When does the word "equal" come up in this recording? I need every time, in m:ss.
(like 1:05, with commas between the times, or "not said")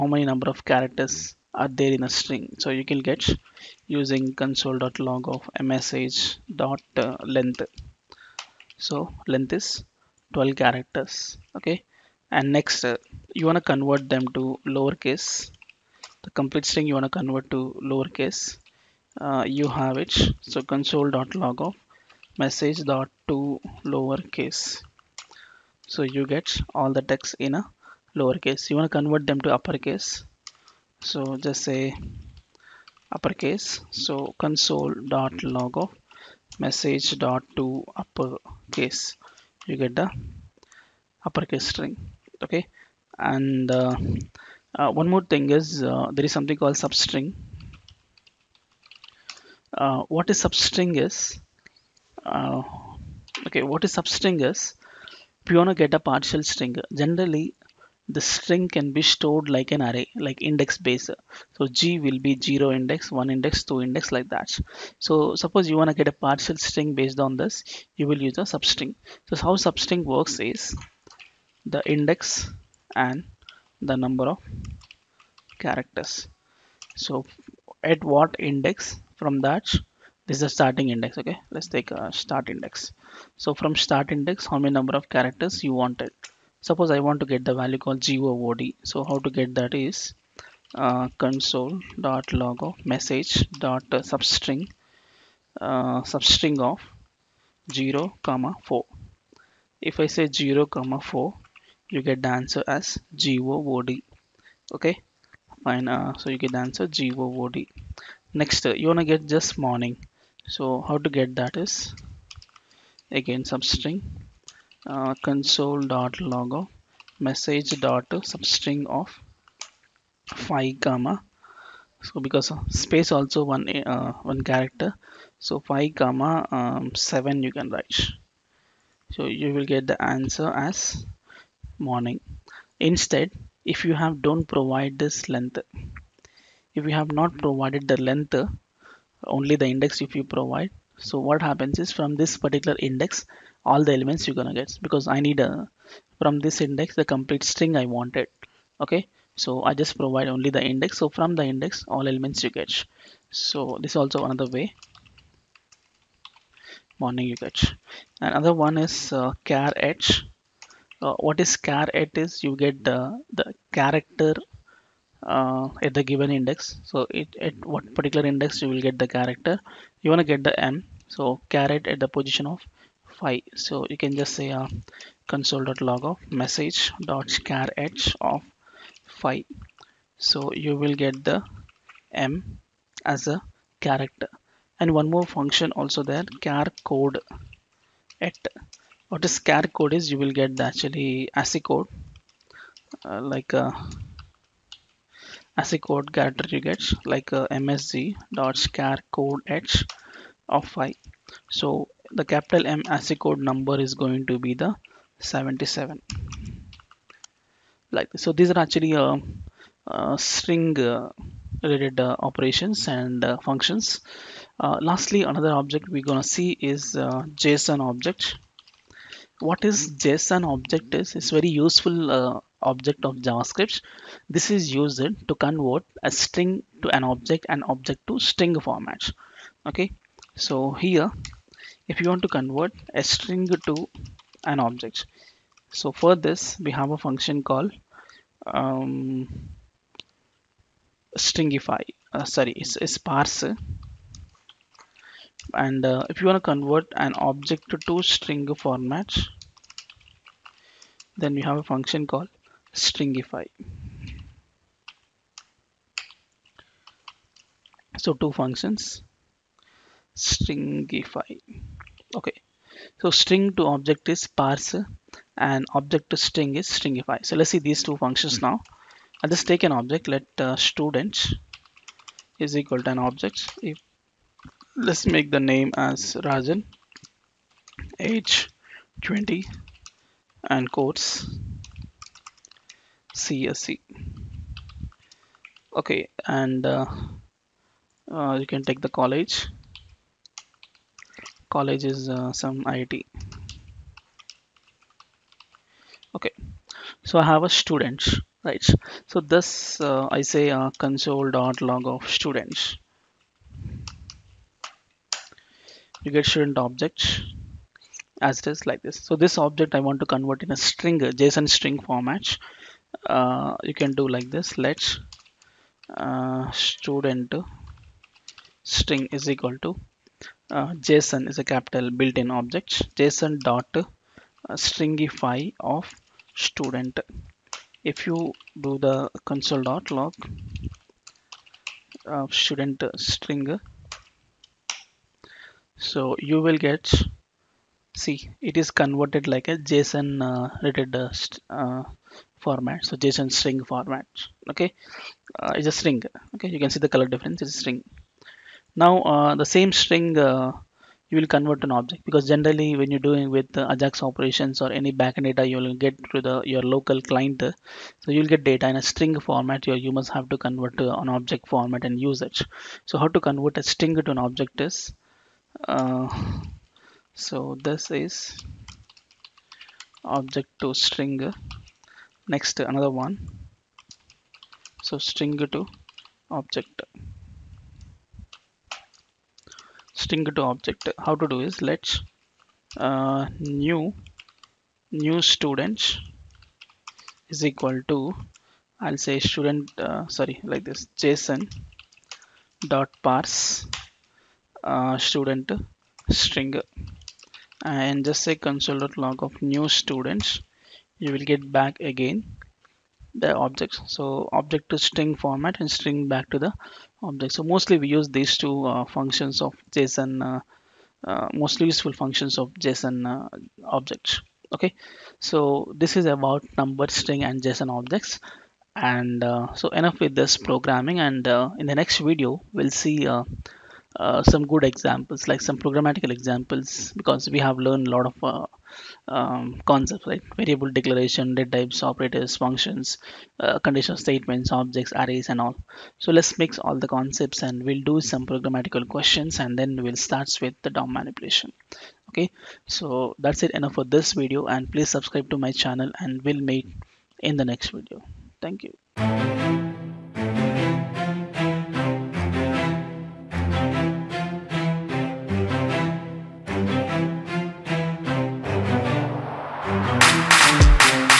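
4:32, 5:19, 6:27.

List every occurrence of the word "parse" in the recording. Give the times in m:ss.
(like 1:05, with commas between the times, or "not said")
4:02, 4:24, 6:33.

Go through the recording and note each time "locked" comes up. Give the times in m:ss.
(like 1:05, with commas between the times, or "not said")
not said.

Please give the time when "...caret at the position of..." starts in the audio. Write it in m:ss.
2:51.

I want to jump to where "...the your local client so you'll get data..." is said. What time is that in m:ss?
5:56.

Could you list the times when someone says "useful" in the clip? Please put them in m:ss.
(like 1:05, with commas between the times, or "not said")
3:41, 6:51.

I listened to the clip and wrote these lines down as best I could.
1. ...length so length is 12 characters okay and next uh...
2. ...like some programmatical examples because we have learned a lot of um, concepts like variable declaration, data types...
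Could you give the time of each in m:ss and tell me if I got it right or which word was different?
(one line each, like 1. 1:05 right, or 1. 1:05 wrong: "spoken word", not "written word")
1. 0:07 right
2. 7:05 right.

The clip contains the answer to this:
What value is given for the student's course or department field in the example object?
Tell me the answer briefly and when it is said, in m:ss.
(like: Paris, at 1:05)
CSC, at 4:43.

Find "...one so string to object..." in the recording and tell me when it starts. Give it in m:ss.
6:13.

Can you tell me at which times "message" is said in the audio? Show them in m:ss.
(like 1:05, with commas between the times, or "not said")
0:22, 0:36, 1:32, 1:57, 2:56.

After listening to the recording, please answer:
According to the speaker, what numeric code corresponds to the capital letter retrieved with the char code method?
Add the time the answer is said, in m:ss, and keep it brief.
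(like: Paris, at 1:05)
77, at 3:25.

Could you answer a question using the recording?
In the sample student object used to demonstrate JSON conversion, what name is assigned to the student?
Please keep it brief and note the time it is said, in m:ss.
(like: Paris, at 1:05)
Rajan, at 4:36.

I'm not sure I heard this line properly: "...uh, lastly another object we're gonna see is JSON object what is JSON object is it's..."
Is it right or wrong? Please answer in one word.
right.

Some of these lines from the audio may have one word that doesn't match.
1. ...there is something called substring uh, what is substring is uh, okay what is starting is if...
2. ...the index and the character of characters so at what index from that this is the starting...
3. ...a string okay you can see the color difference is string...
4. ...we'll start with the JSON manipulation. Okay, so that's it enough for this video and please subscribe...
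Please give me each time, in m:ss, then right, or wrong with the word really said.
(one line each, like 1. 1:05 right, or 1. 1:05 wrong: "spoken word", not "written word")
1. 0:46 wrong: "substring", not "starting"
2. 1:11 wrong: "number", not "character"
3. 5:45 right
4. 7:19 wrong: "DOM", not "JSON".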